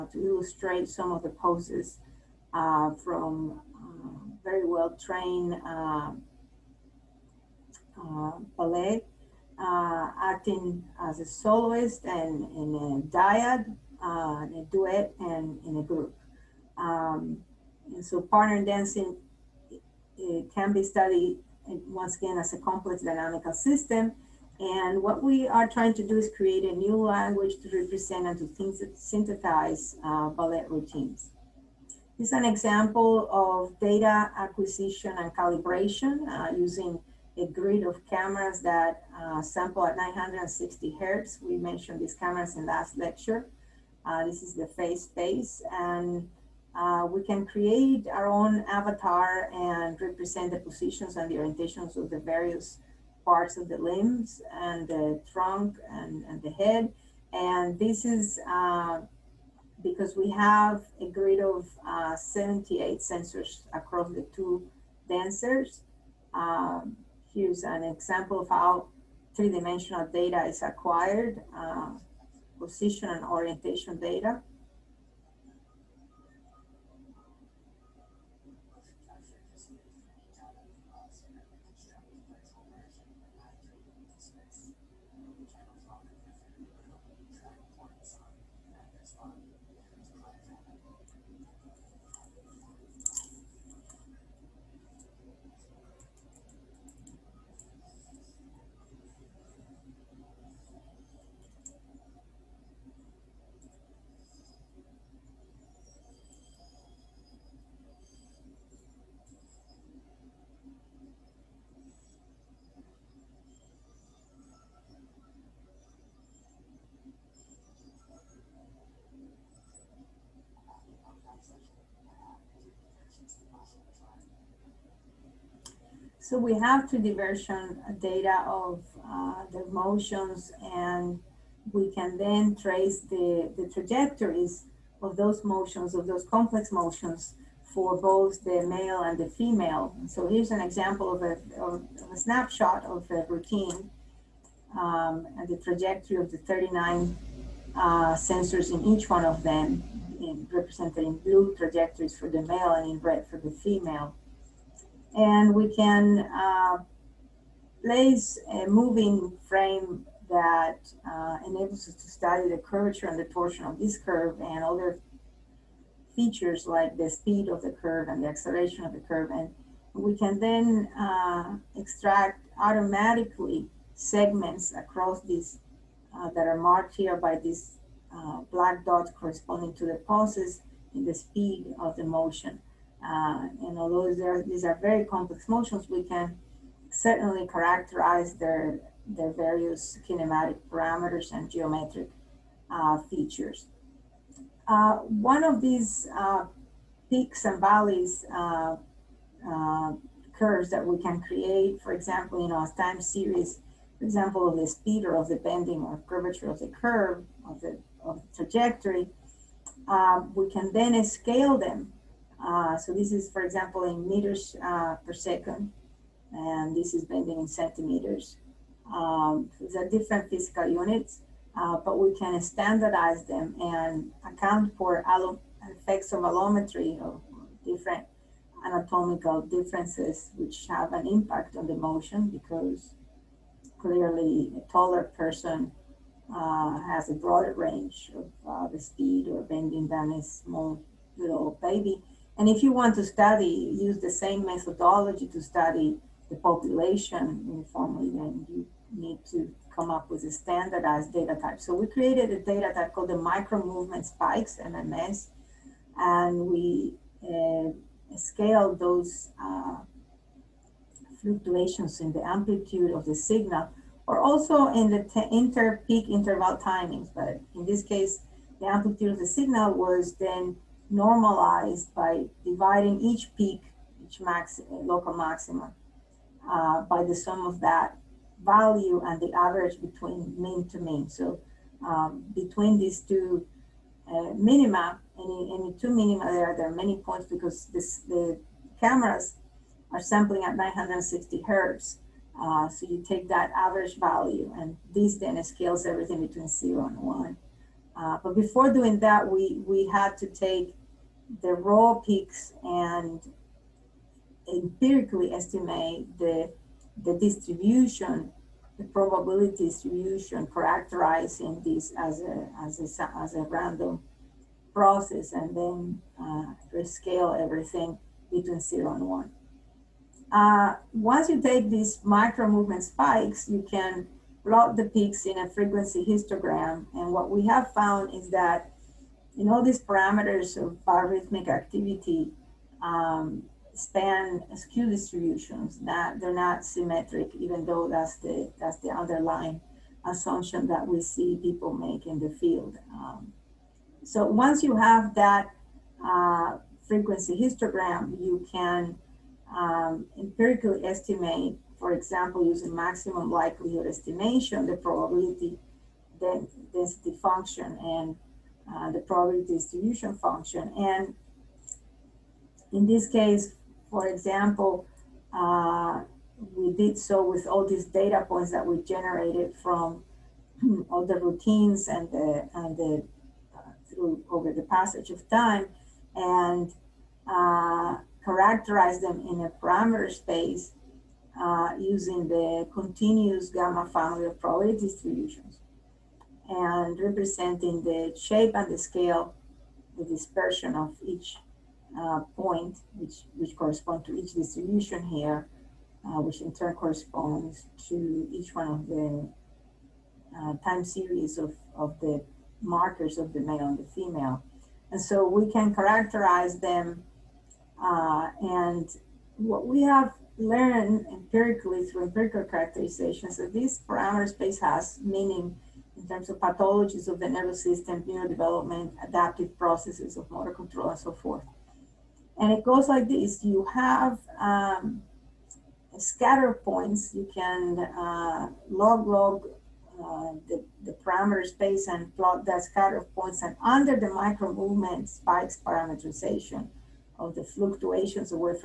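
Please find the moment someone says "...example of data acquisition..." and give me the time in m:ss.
0:32.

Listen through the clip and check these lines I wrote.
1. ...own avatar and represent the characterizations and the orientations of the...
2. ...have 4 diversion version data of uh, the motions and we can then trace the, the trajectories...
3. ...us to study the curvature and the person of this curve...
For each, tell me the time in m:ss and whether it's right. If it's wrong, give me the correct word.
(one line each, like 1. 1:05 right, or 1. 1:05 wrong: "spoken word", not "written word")
1. 0:48 wrong: "positions", not "characterizations"
2. 2:06 wrong: "3", not "4"
3. 2:41 wrong: "torsion", not "person".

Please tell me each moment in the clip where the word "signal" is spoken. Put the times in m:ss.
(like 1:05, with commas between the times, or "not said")
4:23, 4:29.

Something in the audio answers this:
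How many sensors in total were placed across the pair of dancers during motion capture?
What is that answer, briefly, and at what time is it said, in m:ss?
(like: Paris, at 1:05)
78, at 1:02.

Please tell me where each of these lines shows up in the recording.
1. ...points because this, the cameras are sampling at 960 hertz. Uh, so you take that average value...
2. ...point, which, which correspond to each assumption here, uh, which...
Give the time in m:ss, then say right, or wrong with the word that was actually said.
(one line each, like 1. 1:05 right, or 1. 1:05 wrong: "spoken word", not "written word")
1. 4:46 right
2. 6:32 wrong: "distribution", not "assumption".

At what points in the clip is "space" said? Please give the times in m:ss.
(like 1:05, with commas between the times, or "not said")
0:45, 6:20, 6:54, 7:11.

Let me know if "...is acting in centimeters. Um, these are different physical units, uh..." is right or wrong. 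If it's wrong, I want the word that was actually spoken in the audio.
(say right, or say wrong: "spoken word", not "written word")
wrong: "bending", not "acting".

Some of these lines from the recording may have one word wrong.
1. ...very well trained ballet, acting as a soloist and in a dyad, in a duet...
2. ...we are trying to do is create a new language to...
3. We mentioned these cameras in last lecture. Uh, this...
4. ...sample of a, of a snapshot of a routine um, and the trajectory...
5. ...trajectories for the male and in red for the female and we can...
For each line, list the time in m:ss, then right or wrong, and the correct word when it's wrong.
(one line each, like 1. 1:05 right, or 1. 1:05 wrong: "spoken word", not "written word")
1. 0:04 right
2. 0:25 right
3. 0:41 right
4. 2:20 wrong: "example", not "sample"
5. 2:31 right.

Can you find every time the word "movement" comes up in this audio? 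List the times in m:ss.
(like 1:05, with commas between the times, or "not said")
4:13, 5:22, 7:14.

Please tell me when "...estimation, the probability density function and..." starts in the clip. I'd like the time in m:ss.
5:53.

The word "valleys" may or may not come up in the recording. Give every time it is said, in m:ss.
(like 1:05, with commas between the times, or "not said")
3:17.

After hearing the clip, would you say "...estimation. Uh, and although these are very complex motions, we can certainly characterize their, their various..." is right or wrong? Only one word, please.
wrong.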